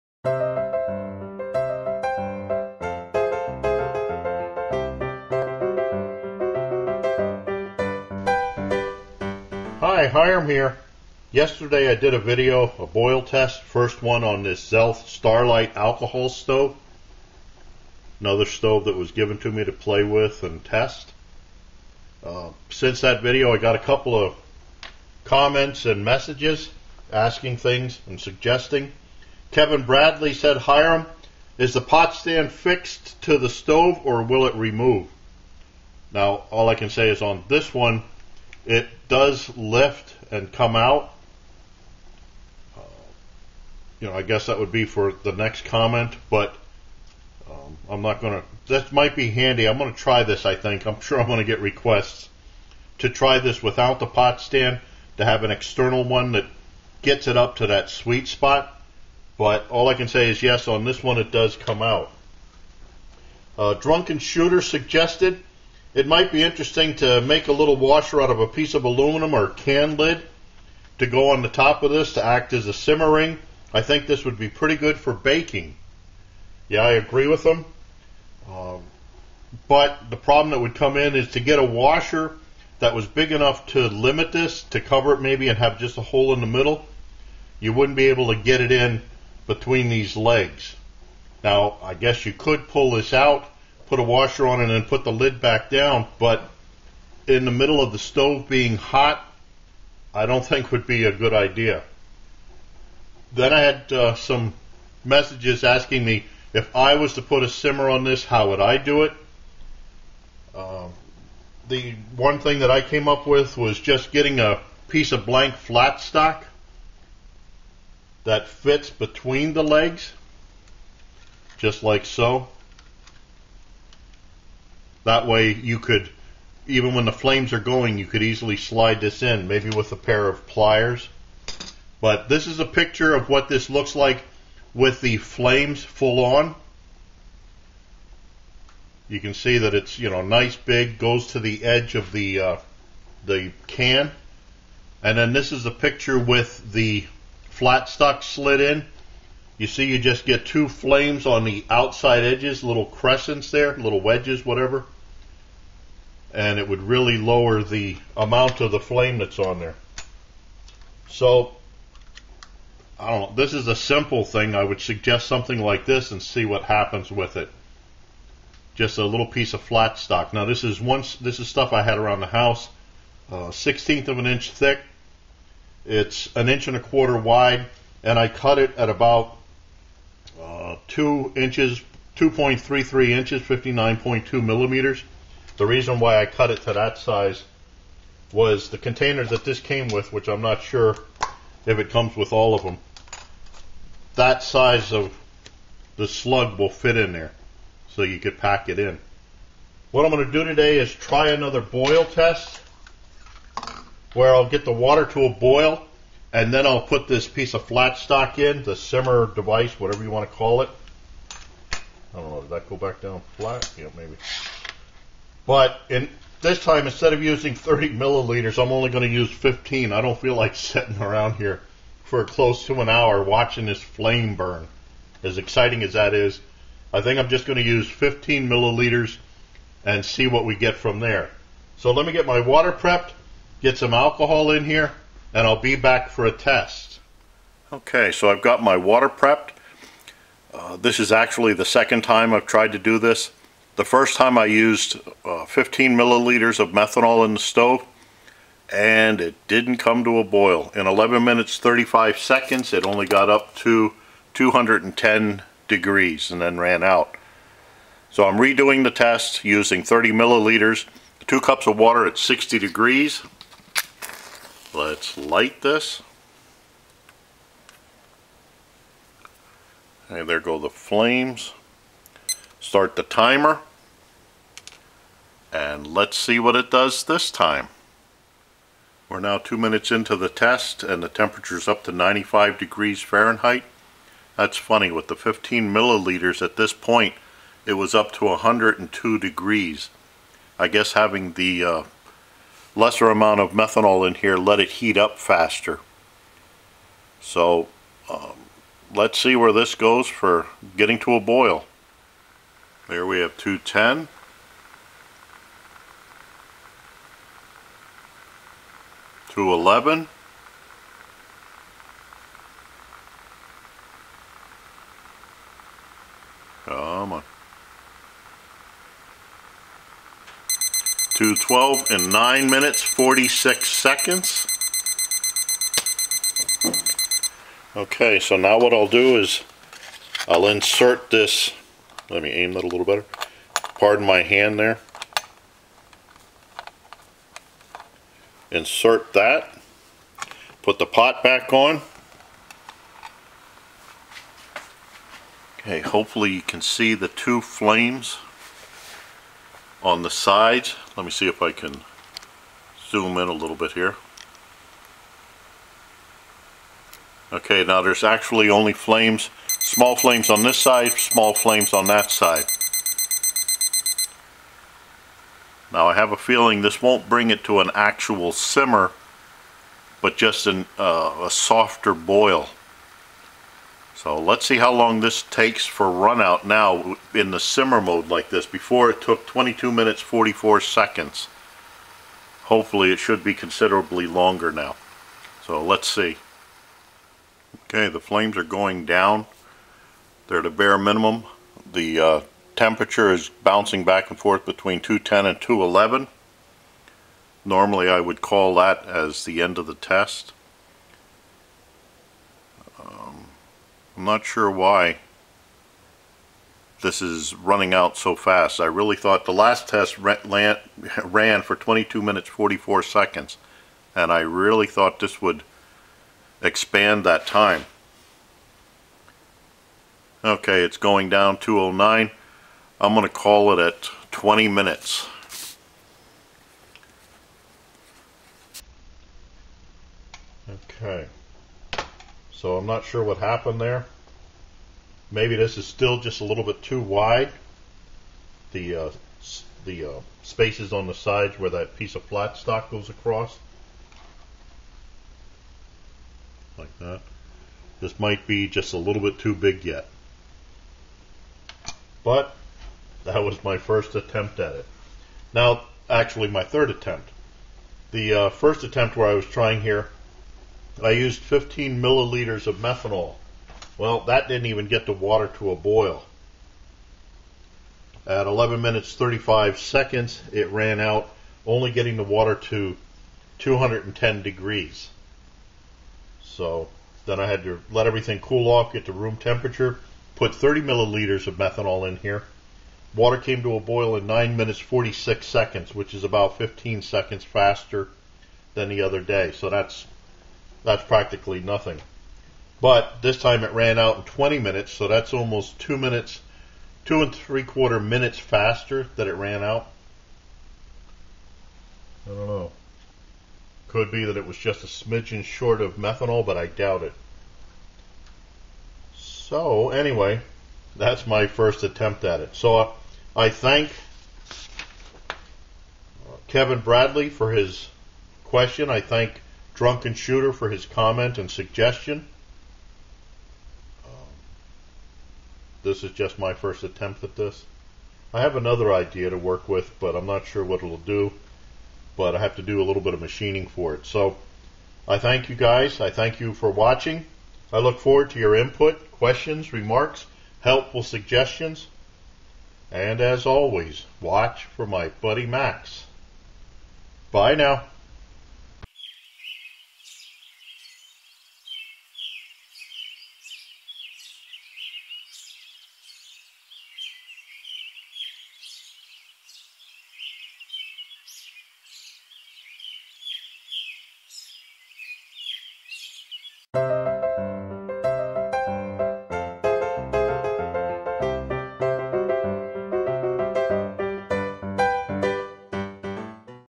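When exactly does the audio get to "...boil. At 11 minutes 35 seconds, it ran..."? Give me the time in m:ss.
7:45.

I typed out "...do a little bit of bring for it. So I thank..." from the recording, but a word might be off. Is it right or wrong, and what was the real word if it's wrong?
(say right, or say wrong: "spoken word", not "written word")
wrong: "machining", not "bring".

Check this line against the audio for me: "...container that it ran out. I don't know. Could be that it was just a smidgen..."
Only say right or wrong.
wrong.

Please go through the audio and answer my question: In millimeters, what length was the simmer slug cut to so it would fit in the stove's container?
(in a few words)
59.2 mm.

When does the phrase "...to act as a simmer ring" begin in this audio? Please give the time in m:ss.
1:12.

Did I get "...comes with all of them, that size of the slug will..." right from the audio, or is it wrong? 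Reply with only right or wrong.
right.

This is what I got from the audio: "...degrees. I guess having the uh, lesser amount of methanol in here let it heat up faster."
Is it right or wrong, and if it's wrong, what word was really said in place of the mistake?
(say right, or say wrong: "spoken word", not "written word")
right.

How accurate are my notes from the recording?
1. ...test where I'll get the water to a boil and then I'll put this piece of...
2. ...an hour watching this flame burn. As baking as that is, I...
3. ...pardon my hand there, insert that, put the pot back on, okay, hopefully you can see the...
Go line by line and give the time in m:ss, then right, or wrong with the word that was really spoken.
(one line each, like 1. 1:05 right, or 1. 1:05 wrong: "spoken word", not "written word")
1. 3:22 right
2. 3:42 wrong: "exciting", not "baking"
3. 5:33 right.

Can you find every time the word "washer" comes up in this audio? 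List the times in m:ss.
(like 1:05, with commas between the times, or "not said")
1:07, 1:21, 1:34.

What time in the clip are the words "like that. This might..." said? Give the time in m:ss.
7:26.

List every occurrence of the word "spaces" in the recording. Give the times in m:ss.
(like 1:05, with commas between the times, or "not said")
7:20.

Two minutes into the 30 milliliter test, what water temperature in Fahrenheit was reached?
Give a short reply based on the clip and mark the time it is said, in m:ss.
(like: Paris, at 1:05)
95 degrees, at 4:41.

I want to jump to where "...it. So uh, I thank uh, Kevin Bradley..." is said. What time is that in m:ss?
8:32.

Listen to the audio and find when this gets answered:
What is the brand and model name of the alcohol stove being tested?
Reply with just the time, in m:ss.
0:14.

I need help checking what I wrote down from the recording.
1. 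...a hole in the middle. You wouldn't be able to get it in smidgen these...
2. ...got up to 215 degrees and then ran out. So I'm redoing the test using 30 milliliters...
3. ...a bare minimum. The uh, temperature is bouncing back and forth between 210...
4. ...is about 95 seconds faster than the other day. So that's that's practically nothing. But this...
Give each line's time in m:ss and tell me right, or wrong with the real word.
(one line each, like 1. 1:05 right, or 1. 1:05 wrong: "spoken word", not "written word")
1. 1:25 wrong: "between", not "smidgen"
2. 4:13 wrong: "210", not "215"
3. 6:30 right
4. 8:05 wrong: "15", not "95".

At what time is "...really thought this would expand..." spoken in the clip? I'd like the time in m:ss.
6:54.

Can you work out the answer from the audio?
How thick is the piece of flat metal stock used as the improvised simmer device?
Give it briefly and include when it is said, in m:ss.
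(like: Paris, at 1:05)
1/16 inch, at 2:53.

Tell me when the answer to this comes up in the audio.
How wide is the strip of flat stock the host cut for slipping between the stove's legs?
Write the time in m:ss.
2:56.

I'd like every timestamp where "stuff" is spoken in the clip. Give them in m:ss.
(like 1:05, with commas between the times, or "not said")
2:51.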